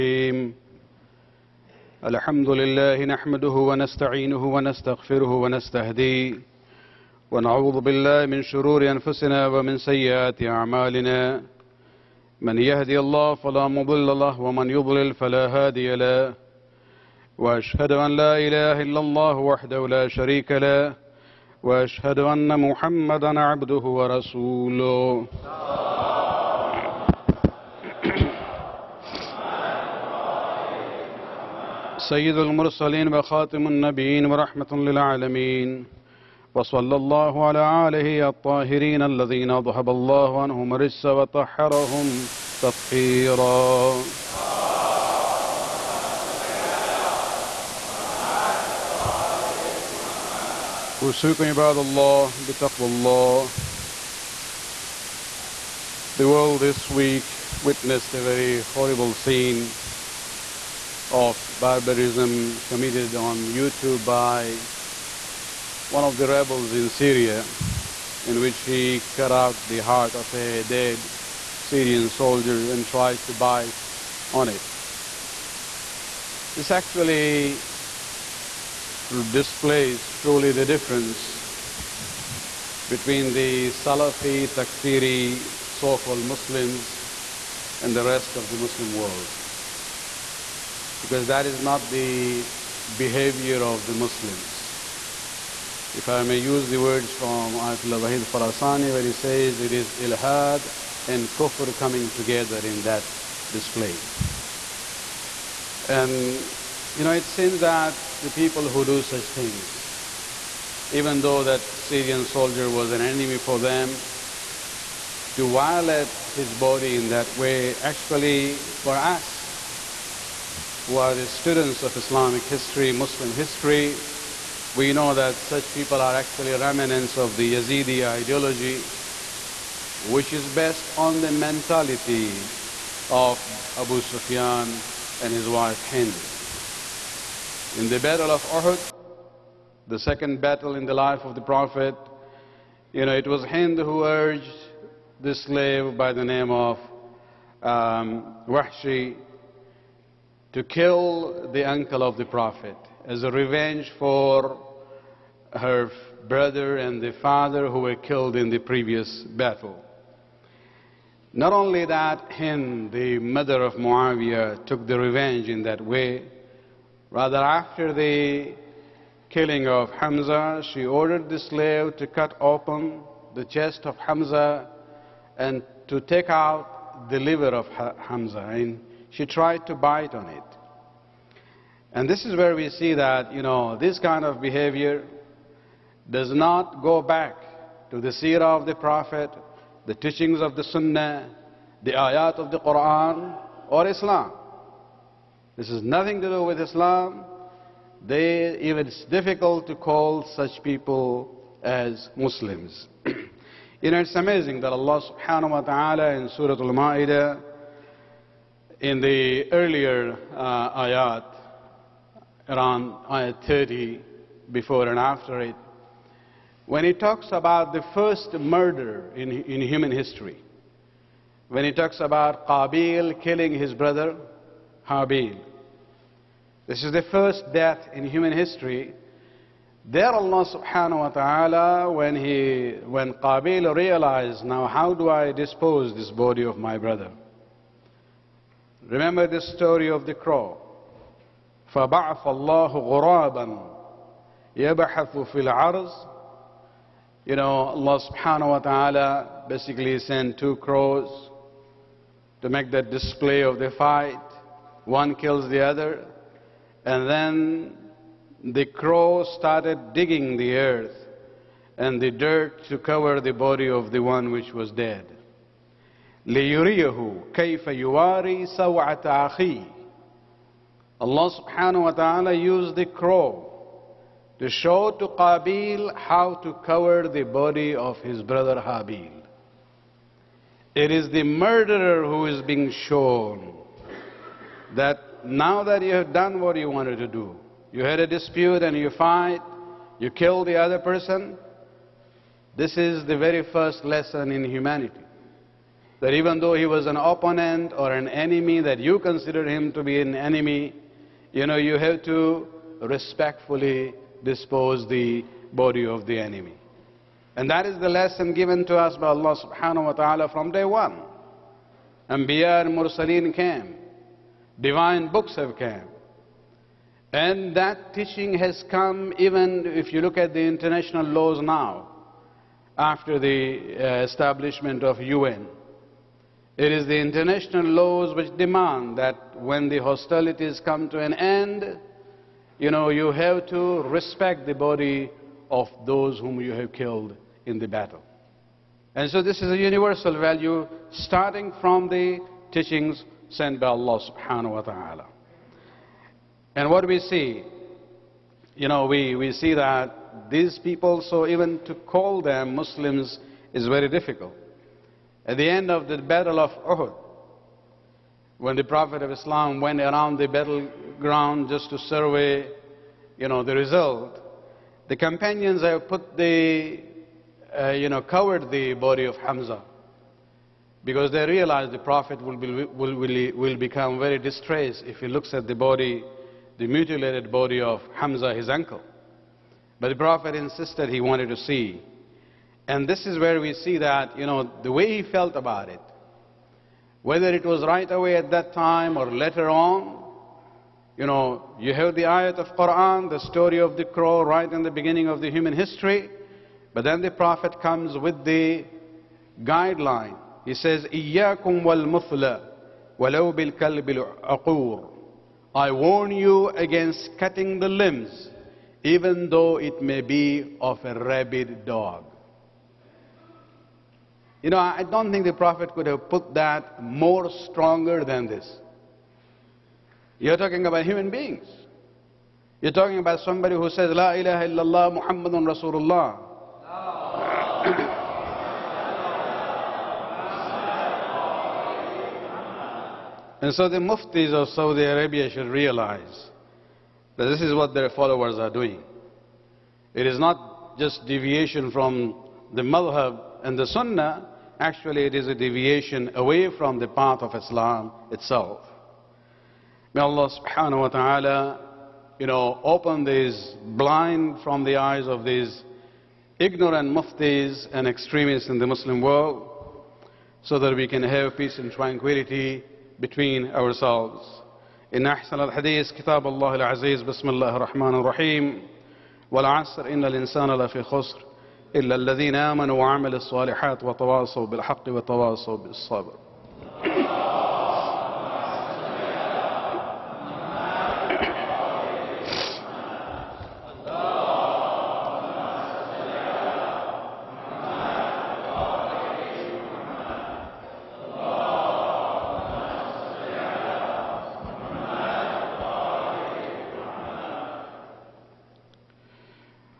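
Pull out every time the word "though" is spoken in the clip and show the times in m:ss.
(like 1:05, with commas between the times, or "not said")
1:51, 4:56, 6:49.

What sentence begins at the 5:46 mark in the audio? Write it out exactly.
And what we see, you know, we, we see that these people, so even to call them Muslims is very difficult.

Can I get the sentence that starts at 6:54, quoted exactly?
You know, I don't think the Prophet could have put that more stronger than this.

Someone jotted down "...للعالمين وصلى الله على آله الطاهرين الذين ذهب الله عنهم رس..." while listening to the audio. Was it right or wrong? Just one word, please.
right.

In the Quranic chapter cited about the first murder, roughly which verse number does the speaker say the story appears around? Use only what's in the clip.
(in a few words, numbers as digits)
30.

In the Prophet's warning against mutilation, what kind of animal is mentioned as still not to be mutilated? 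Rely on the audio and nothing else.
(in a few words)
Rabid dog.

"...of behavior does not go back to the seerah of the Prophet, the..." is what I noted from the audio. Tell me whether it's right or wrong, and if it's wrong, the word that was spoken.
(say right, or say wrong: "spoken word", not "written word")
right.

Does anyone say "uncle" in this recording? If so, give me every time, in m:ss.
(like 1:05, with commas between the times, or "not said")
2:31, 6:18.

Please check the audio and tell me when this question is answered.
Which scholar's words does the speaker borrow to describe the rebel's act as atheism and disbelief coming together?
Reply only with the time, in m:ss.
1:37.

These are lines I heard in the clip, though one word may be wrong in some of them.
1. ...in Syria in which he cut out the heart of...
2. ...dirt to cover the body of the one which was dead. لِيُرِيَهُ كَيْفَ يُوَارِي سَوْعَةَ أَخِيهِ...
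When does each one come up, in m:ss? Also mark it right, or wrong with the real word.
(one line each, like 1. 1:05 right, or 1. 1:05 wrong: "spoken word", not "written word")
1. 1:06 right
2. 4:22 right.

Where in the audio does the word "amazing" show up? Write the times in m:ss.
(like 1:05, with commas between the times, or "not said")
3:24.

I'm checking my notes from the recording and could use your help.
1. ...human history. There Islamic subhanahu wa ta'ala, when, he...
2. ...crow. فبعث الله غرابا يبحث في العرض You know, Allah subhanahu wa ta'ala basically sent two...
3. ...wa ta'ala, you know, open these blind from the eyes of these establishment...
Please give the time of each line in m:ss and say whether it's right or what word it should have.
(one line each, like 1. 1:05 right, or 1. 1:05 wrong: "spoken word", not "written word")
1. 3:48 wrong: "Allah", not "Islamic"
2. 4:00 right
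3. 7:30 wrong: "ignorant", not "establishment".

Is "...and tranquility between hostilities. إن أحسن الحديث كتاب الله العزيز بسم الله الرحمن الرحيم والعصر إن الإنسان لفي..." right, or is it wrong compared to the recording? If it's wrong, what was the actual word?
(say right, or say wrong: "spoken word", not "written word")
wrong: "ourselves", not "hostilities".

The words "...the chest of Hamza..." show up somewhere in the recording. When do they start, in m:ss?
2:53.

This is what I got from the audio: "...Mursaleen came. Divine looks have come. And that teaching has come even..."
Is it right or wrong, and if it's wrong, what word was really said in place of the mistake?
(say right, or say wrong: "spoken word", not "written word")
wrong: "books", not "looks".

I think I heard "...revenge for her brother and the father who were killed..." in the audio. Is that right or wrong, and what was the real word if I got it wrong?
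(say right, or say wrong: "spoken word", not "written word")
right.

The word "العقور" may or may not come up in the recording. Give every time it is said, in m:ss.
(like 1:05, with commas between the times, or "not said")
6:43.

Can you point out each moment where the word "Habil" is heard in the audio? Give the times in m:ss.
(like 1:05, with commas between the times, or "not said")
3:44, 4:38.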